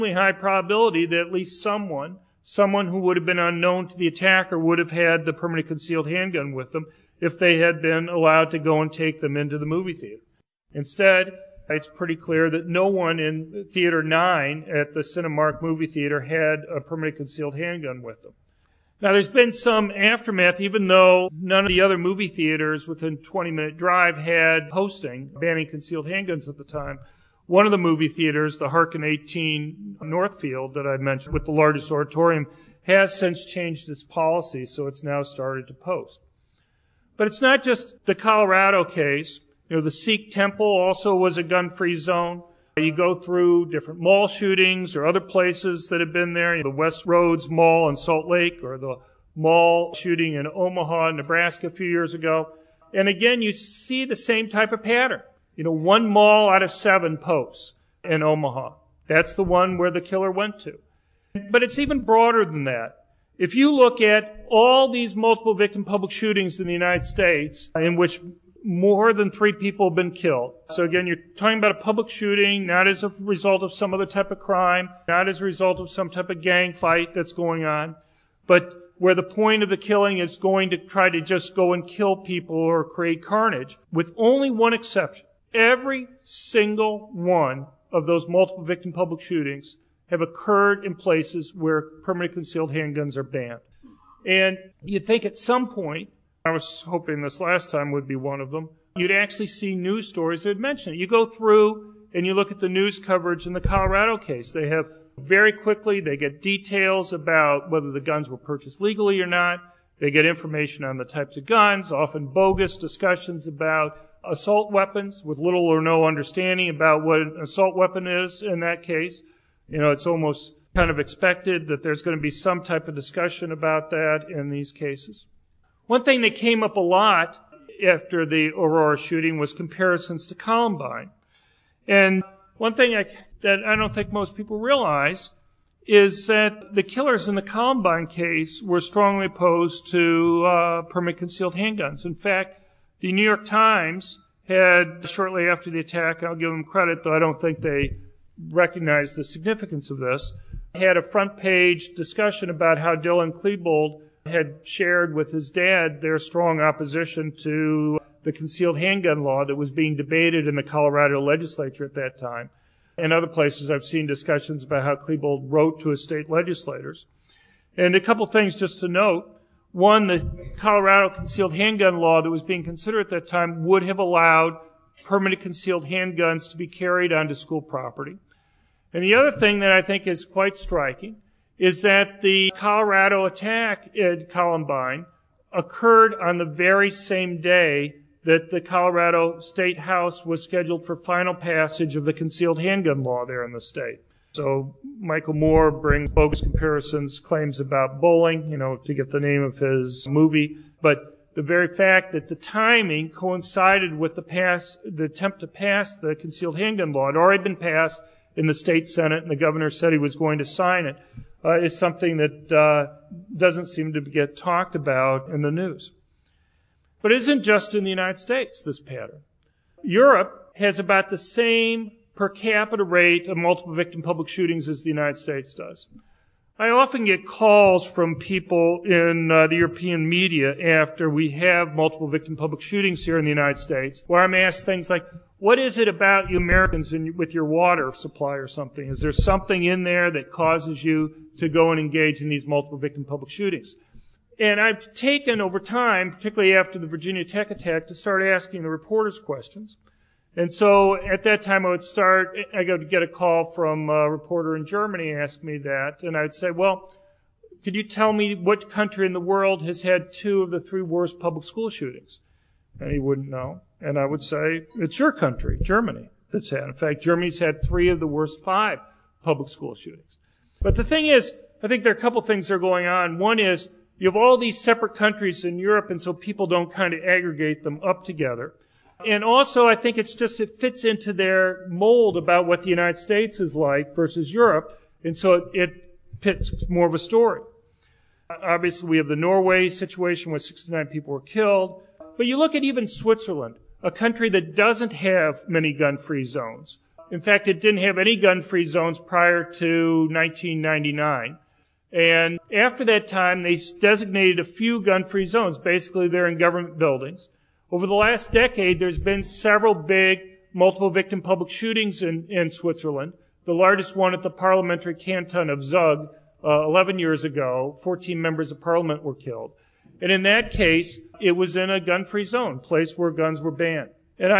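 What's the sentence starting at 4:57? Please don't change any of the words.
In fact, it didn't have any gun-free zones prior to 1999.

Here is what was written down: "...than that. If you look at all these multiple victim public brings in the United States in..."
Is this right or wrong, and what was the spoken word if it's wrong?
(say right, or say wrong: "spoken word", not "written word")
wrong: "shootings", not "brings".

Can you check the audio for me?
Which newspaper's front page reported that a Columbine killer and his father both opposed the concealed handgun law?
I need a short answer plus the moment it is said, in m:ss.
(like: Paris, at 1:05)
The New York Times, at 2:23.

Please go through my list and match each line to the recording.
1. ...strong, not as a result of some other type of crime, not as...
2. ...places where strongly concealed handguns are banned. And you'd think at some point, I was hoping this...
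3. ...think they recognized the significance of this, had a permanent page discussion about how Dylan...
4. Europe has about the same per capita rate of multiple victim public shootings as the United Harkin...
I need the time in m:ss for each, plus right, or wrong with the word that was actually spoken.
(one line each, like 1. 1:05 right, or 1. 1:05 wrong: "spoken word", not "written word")
1. 1:12 wrong: "shooting", not "strong"
2. 1:30 wrong: "permanently", not "strongly"
3. 2:27 wrong: "front", not "permanent"
4. 3:39 wrong: "States", not "Harkin".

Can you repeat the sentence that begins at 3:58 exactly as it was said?
Is there something in there that causes you to go and engage in these multiple victim public shootings?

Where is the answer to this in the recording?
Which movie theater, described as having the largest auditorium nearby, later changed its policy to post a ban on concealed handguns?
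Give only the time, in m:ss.
0:28.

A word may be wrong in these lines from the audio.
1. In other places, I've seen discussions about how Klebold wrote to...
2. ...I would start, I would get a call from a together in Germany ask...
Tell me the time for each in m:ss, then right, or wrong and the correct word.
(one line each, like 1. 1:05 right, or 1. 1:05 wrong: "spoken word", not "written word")
1. 2:42 right
2. 4:11 wrong: "reporter", not "together".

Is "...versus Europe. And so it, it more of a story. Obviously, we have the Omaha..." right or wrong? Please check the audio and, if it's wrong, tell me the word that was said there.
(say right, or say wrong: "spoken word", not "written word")
wrong: "Norway", not "Omaha".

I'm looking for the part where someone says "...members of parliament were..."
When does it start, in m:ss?
5:18.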